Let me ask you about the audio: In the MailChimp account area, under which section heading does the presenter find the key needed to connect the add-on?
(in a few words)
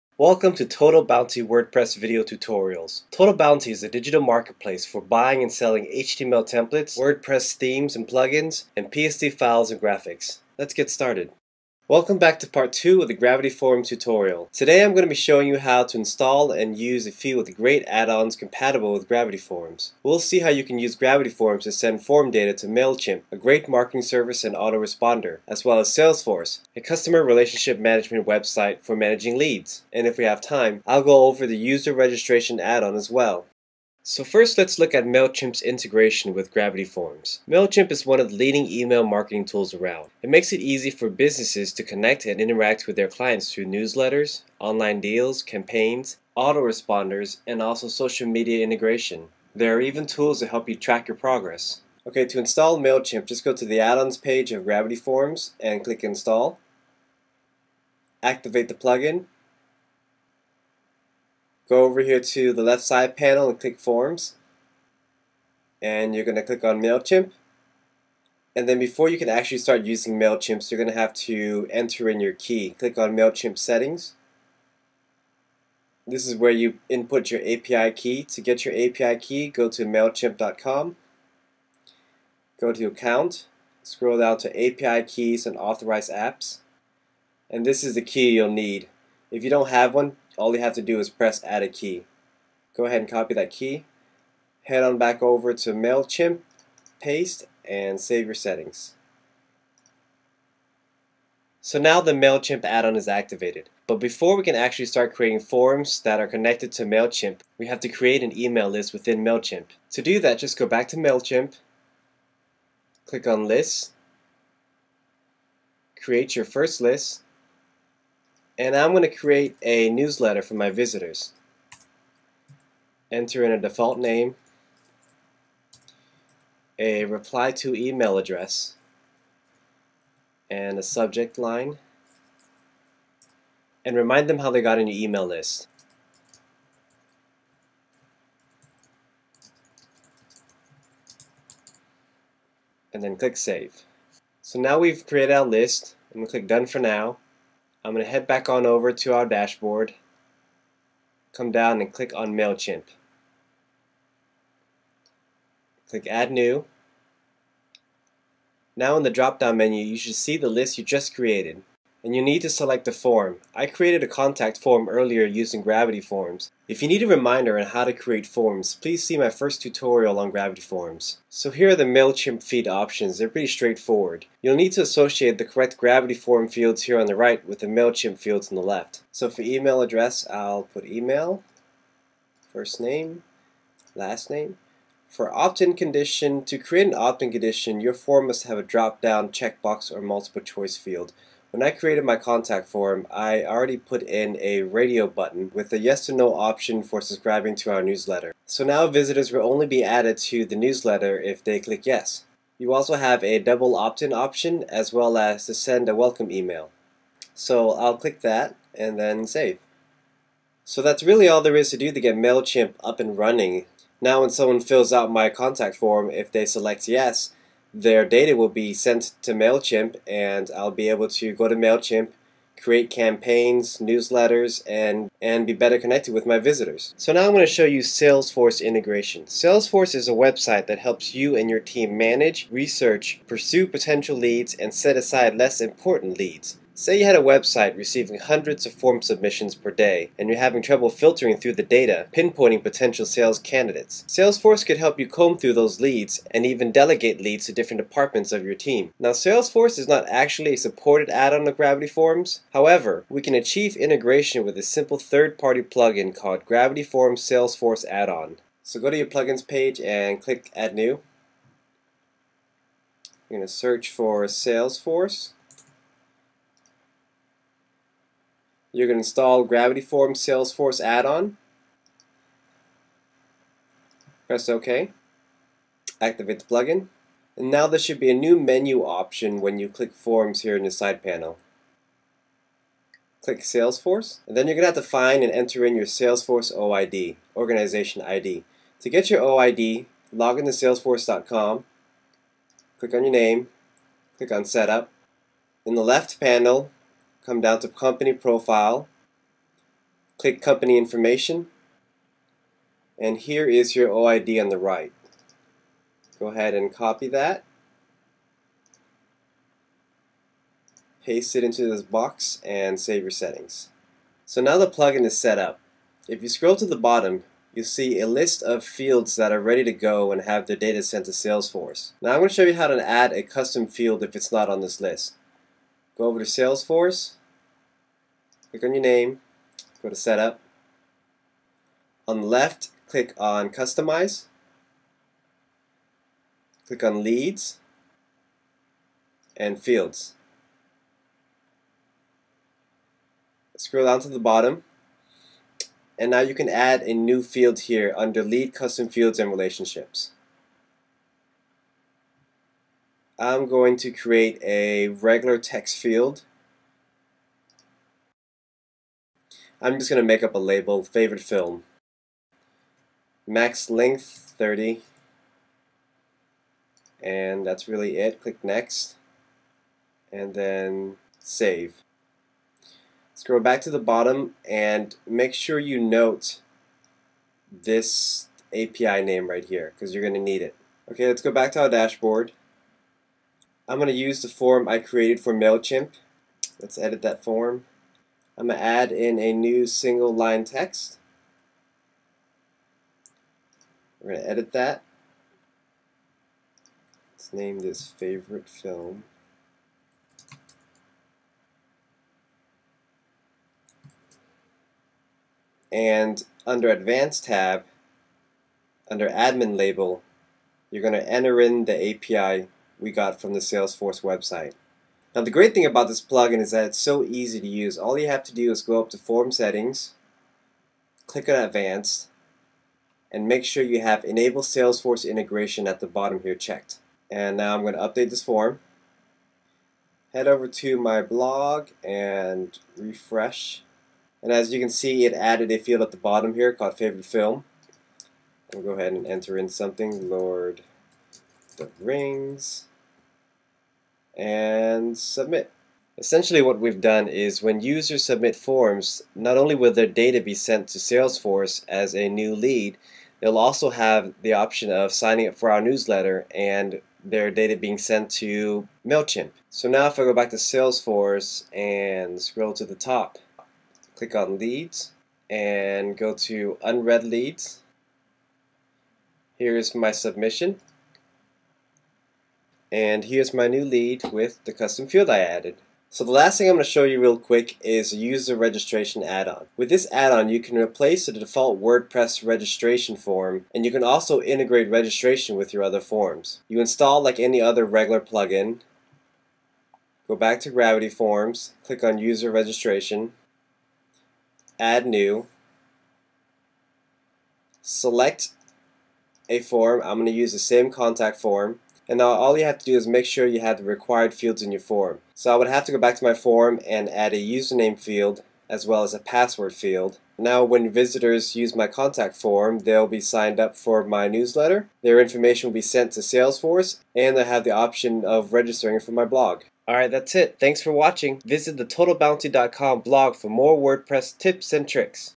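API Keys and Authorized Apps.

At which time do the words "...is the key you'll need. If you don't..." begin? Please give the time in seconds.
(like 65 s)
87 s.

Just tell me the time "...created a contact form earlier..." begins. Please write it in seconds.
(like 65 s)
163 s.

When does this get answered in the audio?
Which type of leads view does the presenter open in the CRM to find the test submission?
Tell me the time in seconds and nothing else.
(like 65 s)
466 s.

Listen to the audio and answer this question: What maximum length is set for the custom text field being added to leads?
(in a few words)
30.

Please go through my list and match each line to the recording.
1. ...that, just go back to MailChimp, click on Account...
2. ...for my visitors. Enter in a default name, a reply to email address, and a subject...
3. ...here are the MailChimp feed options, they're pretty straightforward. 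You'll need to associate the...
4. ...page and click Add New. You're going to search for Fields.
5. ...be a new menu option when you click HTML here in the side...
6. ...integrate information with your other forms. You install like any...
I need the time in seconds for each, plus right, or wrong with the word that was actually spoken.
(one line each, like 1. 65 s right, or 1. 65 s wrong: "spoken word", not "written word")
1. 110 s wrong: "Lists", not "Account"
2. 120 s right
3. 171 s right
4. 259 s wrong: "Salesforce", not "Fields"
5. 277 s wrong: "Forms", not "HTML"
6. 484 s wrong: "registration", not "information".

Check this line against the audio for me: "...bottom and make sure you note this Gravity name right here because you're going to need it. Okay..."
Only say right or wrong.
wrong.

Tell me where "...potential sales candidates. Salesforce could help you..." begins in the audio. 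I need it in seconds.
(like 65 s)
242 s.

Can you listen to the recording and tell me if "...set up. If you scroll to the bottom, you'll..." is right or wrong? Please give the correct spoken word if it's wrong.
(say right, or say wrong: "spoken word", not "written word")
right.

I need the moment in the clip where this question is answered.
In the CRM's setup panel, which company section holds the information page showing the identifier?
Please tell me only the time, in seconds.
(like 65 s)
297 s.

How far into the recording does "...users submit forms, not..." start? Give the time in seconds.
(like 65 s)
447 s.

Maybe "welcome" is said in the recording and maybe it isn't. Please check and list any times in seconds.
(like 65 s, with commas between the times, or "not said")
0 s, 11 s, 205 s.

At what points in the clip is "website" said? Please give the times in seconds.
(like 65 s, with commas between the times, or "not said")
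28 s, 230 s, 237 s, 414 s.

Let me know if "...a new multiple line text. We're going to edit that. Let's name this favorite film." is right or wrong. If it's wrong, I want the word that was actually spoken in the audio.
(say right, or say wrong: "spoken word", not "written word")
wrong: "single", not "multiple".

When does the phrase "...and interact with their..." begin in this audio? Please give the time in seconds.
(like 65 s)
42 s.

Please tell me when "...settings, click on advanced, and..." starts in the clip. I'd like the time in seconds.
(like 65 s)
419 s.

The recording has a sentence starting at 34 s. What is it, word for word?
So first let's look at MailChimp's integration with Gravity Forms.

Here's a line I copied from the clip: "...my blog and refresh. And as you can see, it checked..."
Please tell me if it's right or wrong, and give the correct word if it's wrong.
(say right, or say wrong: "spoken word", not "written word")
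wrong: "added", not "checked".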